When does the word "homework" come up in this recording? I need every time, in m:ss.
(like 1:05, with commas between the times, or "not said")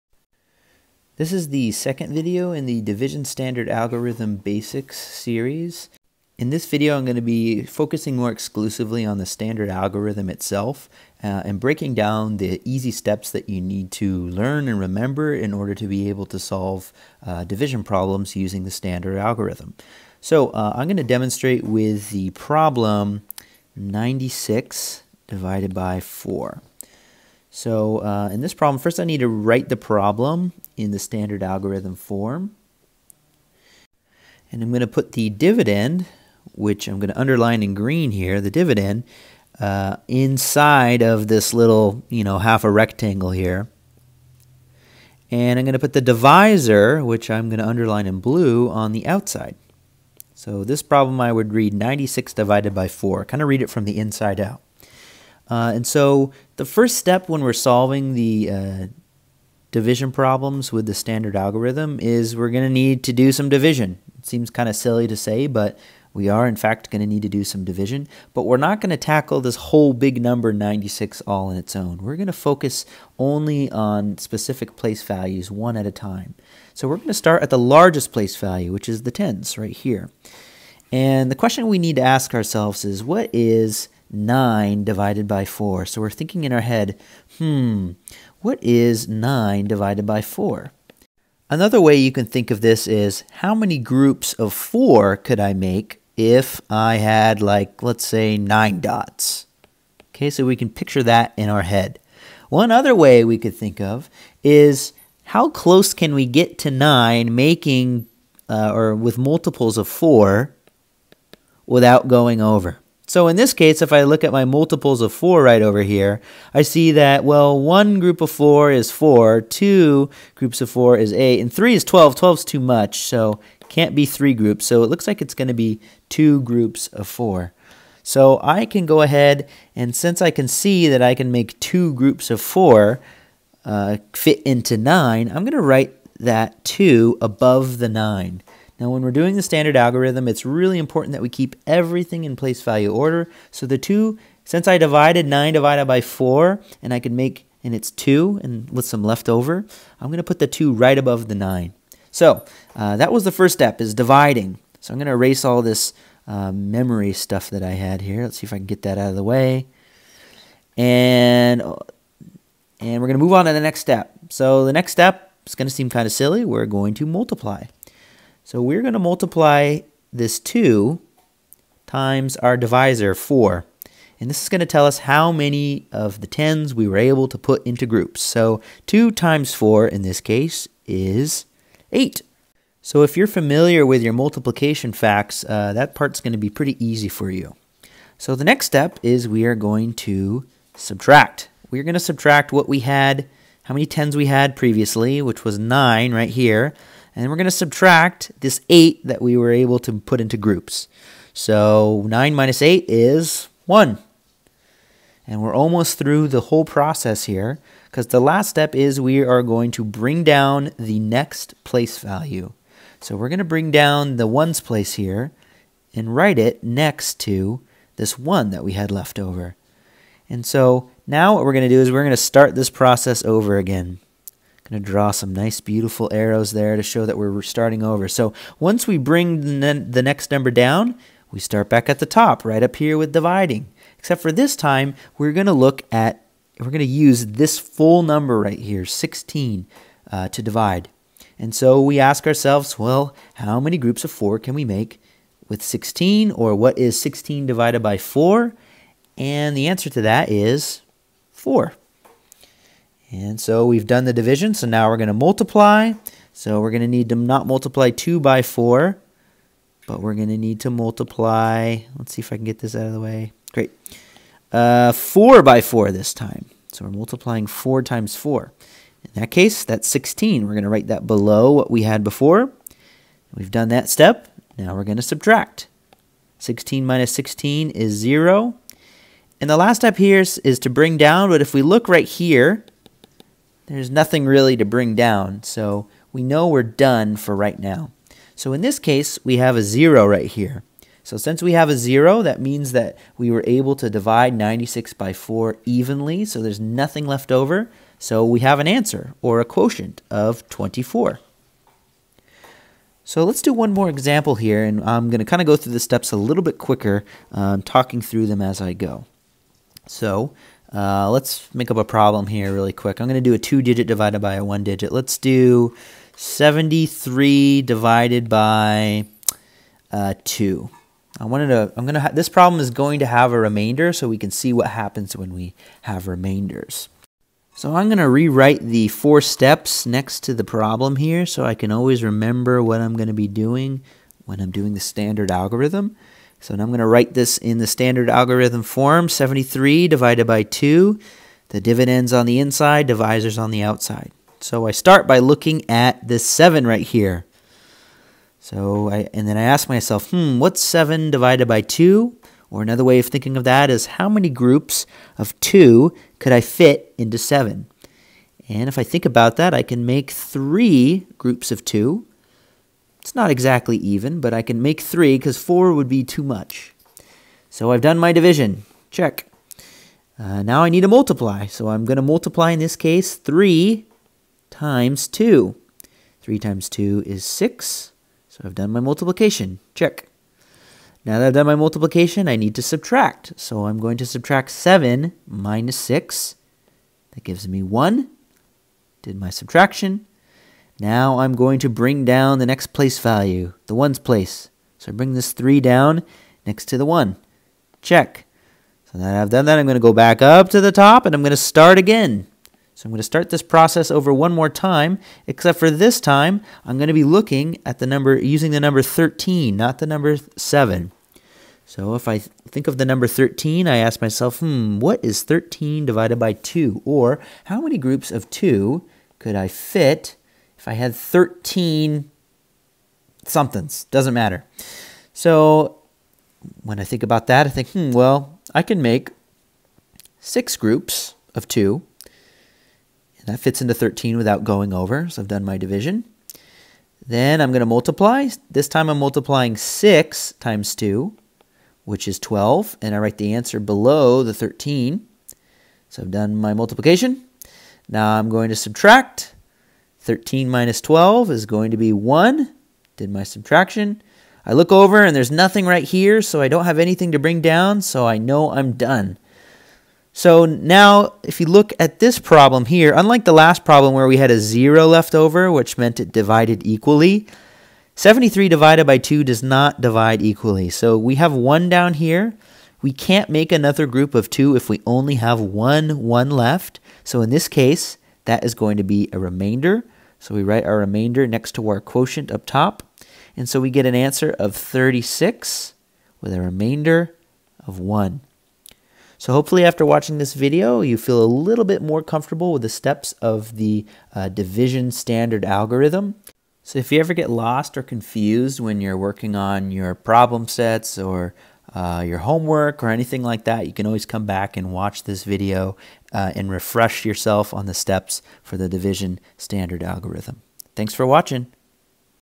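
8:22.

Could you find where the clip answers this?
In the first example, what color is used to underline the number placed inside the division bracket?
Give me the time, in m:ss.
0:37.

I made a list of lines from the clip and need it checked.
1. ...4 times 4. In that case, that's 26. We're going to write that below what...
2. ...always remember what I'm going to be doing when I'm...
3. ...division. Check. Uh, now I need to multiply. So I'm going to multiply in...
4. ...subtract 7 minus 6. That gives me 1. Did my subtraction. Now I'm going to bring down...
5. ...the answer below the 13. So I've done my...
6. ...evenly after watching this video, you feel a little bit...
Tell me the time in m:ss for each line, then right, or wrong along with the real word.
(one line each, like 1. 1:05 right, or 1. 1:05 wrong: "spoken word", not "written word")
1. 4:27 wrong: "16", not "26"
2. 5:31 right
3. 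6:08 right
4. 6:24 right
5. 7:23 right
6. 8:09 wrong: "hopefully", not "evenly".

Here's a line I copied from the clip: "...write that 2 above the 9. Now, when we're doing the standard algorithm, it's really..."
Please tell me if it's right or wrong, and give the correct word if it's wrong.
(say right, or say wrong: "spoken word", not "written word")
right.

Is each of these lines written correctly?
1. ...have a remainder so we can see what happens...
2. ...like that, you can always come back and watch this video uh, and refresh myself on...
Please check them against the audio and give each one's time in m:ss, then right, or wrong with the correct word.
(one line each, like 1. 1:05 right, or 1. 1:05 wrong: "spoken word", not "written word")
1. 5:23 right
2. 8:23 wrong: "yourself", not "myself".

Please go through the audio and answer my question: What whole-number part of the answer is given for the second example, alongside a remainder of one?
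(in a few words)
36.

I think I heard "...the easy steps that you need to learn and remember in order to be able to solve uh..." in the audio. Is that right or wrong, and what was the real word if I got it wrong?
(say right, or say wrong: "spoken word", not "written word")
right.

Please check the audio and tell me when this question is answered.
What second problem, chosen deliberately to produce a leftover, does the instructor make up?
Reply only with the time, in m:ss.
5:16.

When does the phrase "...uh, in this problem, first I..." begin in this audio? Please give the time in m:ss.
0:27.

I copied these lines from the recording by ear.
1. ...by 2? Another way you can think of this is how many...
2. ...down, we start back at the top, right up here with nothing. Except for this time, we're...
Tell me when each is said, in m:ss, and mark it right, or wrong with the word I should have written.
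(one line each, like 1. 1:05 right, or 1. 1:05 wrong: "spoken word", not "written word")
1. 1:30 wrong: "4", not "2"
2. 3:50 wrong: "dividing", not "nothing".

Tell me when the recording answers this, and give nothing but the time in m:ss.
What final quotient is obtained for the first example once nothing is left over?
5:00.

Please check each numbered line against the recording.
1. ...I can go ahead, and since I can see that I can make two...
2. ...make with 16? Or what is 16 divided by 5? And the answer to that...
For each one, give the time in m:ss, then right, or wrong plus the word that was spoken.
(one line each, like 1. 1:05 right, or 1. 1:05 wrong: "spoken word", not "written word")
1. 2:08 right
2. 4:04 wrong: "4", not "5".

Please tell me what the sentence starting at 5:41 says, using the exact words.
The dividend's on the inside, divisor's on the outside.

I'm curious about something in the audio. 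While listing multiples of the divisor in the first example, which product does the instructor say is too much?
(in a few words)
12.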